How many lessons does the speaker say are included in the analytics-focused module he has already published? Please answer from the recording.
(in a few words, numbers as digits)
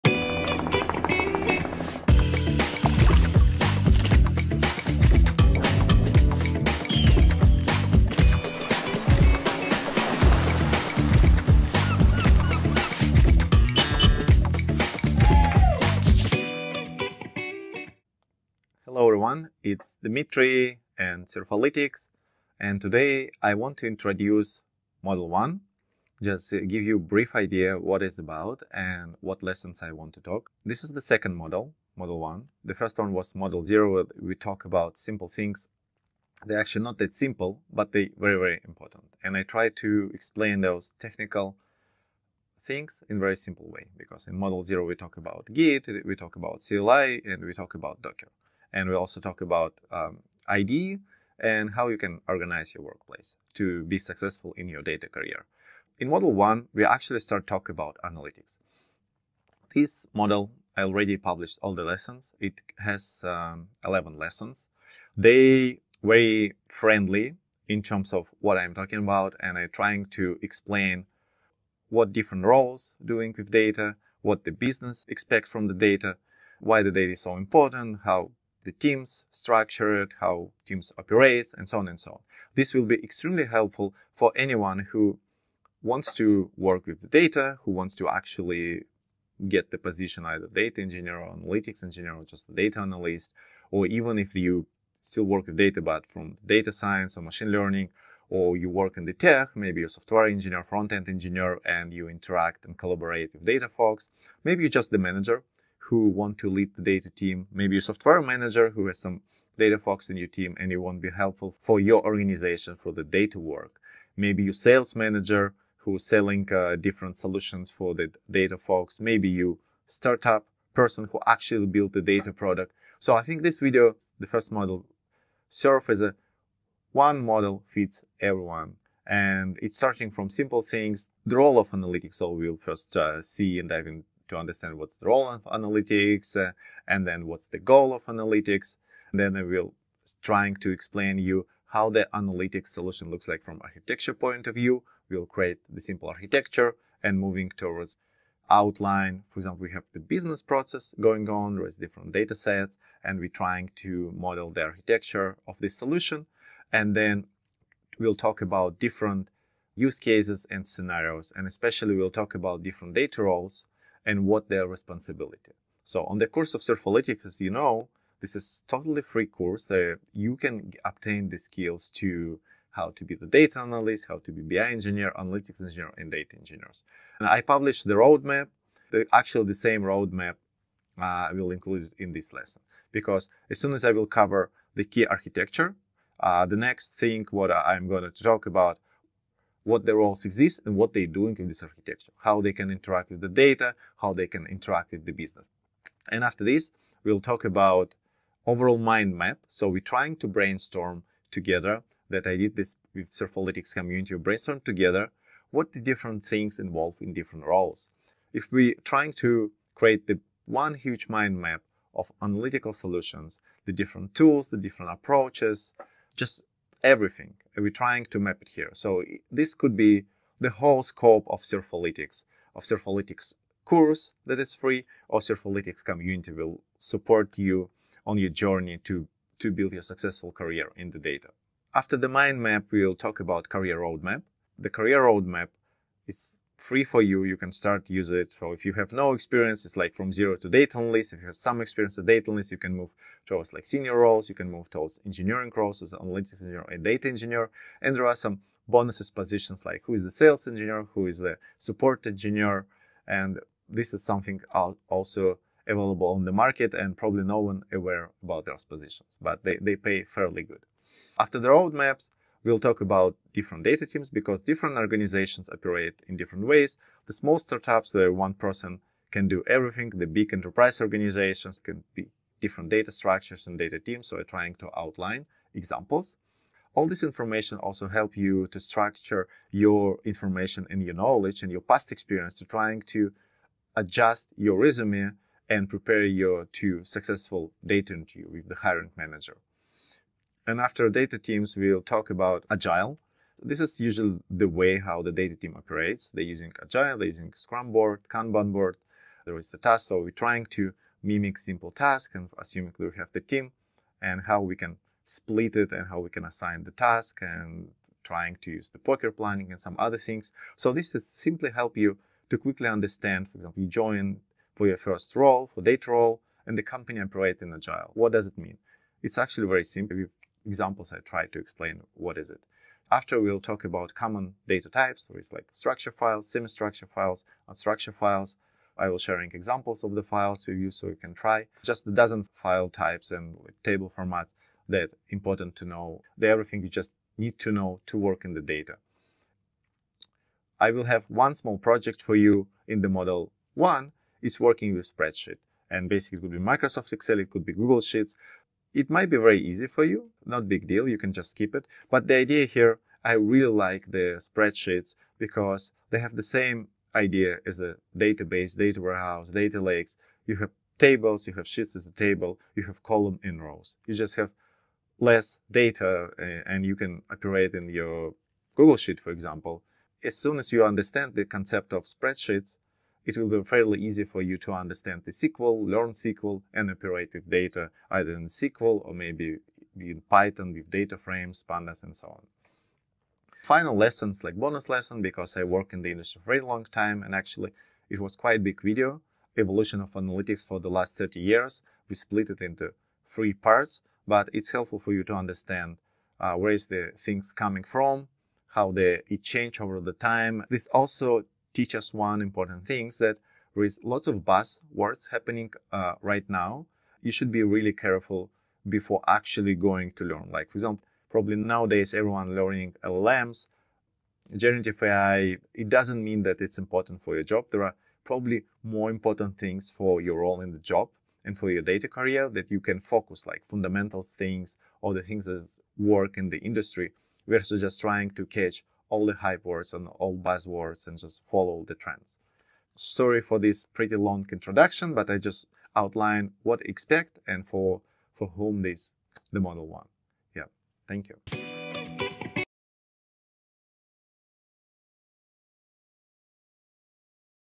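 11.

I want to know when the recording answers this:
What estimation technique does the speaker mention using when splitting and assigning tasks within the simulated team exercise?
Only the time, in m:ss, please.
5:08.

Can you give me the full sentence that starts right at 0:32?
The first one was Model 0, we talk about simple things.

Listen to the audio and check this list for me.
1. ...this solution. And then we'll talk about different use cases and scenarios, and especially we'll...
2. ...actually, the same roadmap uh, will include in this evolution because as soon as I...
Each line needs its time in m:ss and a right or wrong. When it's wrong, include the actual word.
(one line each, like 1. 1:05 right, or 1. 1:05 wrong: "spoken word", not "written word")
1. 2:35 right
2. 2:59 wrong: "lesson", not "evolution".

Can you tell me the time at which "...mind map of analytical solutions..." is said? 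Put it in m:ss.
3:31.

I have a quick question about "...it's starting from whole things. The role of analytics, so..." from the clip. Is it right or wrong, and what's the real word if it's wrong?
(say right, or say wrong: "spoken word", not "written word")
wrong: "simple", not "whole".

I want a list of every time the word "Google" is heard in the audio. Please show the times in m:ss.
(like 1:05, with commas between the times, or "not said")
5:47, 6:08.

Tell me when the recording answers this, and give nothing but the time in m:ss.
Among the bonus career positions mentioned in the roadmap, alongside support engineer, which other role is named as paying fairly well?
4:10.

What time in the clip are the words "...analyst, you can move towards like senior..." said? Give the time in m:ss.
4:02.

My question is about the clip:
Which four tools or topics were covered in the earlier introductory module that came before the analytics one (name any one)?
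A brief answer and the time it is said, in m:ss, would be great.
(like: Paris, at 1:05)
Git, at 0:45.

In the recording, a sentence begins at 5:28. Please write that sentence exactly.
I will sharing examples of the files you use so you can try.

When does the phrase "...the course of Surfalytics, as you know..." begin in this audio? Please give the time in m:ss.
2:46.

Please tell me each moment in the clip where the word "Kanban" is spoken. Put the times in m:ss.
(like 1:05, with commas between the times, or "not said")
4:58.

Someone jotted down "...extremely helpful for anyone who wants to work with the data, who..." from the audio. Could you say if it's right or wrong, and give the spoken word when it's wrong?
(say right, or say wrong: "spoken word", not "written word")
right.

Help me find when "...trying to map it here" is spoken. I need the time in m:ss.
3:37.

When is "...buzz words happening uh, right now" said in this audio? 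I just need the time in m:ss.
6:44.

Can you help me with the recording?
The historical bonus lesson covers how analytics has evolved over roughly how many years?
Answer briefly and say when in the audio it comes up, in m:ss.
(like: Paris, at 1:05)
30 years, at 6:30.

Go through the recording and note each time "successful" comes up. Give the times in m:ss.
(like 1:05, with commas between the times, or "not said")
0:53, 3:49, 4:46.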